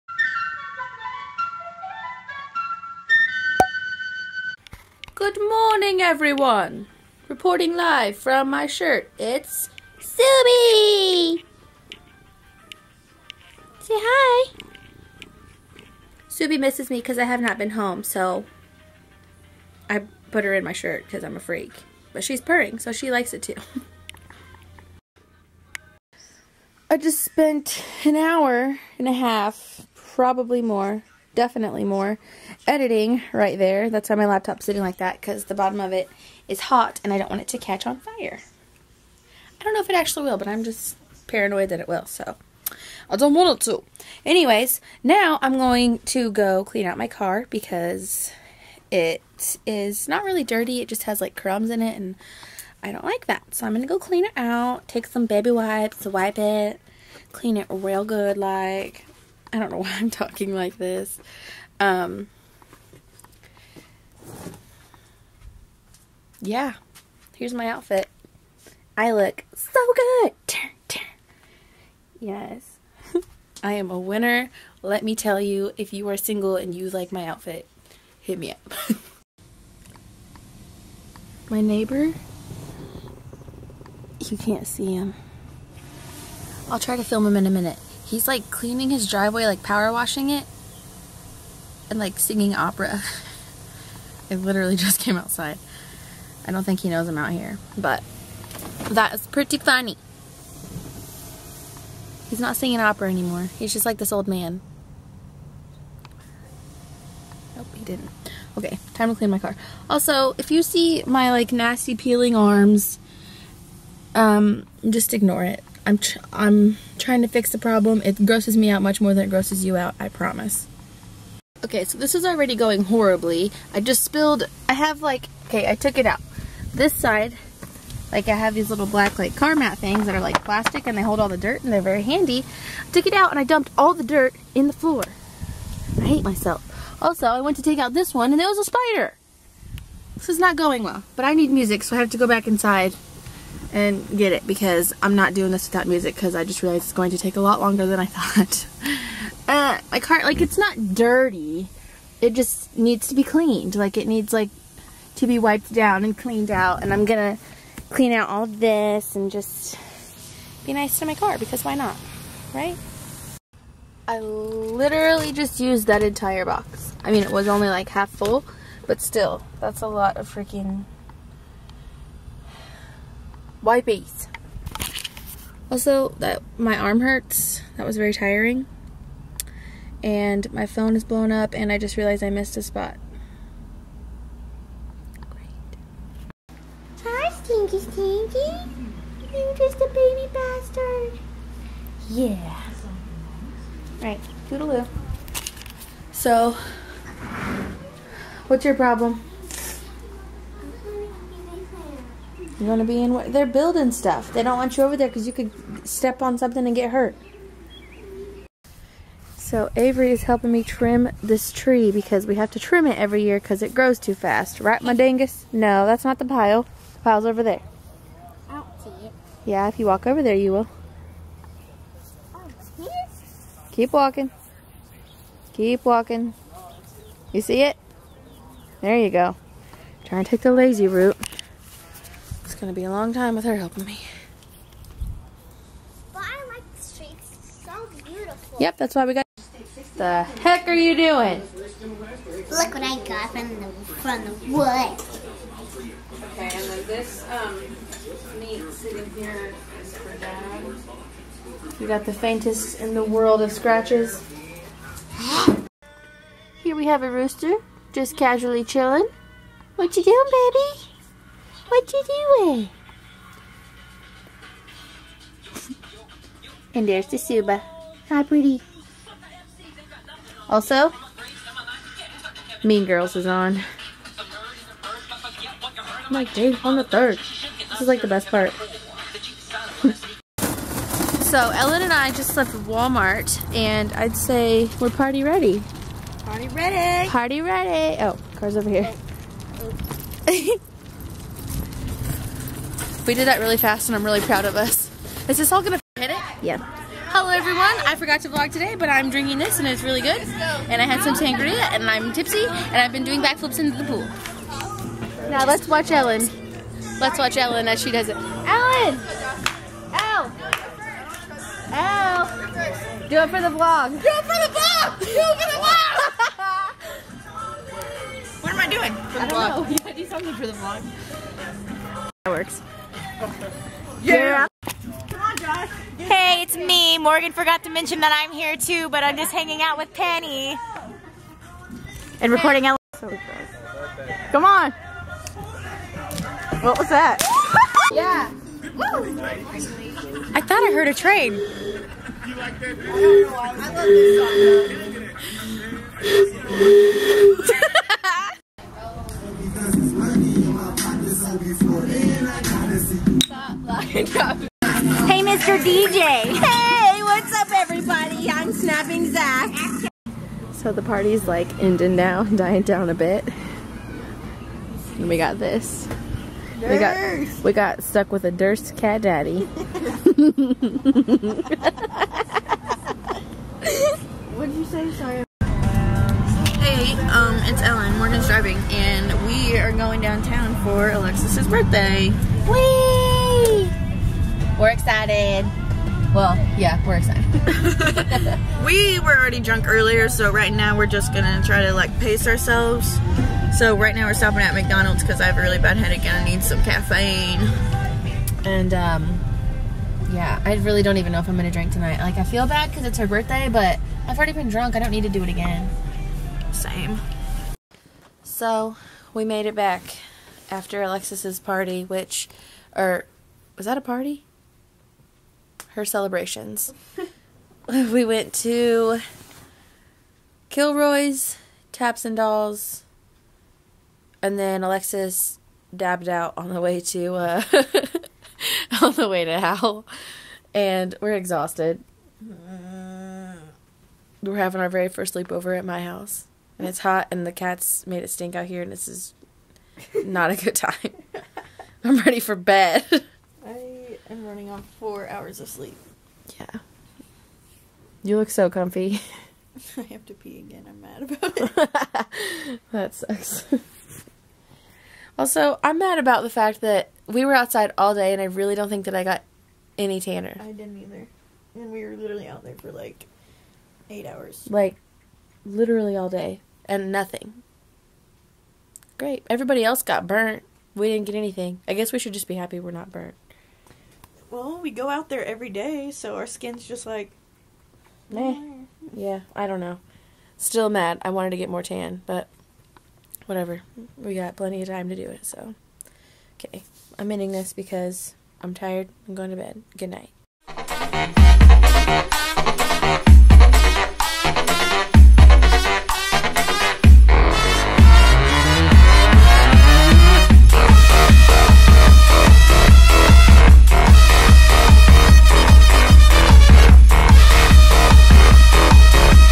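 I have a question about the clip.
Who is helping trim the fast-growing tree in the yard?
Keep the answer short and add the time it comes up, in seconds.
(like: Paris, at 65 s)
Avery, at 209 s.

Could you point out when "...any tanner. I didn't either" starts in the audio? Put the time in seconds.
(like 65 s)
459 s.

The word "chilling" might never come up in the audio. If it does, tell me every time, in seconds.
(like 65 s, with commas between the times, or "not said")
258 s.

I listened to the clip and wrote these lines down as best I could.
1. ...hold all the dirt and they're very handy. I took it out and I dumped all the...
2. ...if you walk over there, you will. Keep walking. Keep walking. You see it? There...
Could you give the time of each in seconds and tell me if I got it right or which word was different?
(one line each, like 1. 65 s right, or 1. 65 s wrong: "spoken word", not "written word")
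1. 131 s right
2. 219 s right.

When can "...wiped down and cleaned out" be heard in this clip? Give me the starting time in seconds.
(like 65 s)
155 s.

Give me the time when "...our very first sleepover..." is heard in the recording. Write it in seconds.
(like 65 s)
434 s.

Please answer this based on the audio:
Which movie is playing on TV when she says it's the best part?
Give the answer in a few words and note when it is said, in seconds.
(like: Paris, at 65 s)
Mean Girls, at 272 s.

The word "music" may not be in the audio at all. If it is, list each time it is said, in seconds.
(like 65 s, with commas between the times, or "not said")
141 s, 145 s.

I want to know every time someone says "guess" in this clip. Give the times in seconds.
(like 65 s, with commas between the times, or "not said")
471 s.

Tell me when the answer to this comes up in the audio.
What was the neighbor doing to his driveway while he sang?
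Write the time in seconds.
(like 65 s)
89 s.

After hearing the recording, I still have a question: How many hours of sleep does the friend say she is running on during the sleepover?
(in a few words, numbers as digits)
4.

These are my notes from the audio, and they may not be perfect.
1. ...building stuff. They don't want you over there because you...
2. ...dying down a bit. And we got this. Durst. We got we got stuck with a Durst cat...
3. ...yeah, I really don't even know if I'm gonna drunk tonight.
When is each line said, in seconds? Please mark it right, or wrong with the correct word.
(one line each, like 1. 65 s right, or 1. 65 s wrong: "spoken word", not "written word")
1. 203 s right
2. 362 s right
3. 400 s wrong: "drink", not "drunk".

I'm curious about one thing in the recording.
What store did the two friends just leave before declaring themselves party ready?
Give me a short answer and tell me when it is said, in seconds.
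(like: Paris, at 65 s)
Walmart, at 282 s.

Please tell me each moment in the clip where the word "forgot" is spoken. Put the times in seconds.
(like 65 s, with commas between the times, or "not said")
297 s, 327 s.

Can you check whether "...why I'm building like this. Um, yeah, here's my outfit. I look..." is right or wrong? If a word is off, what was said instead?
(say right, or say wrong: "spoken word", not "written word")
wrong: "talking", not "building".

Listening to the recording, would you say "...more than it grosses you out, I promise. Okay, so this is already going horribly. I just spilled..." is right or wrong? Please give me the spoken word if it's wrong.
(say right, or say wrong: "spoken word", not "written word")
right.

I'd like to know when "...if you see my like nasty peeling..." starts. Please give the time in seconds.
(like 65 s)
110 s.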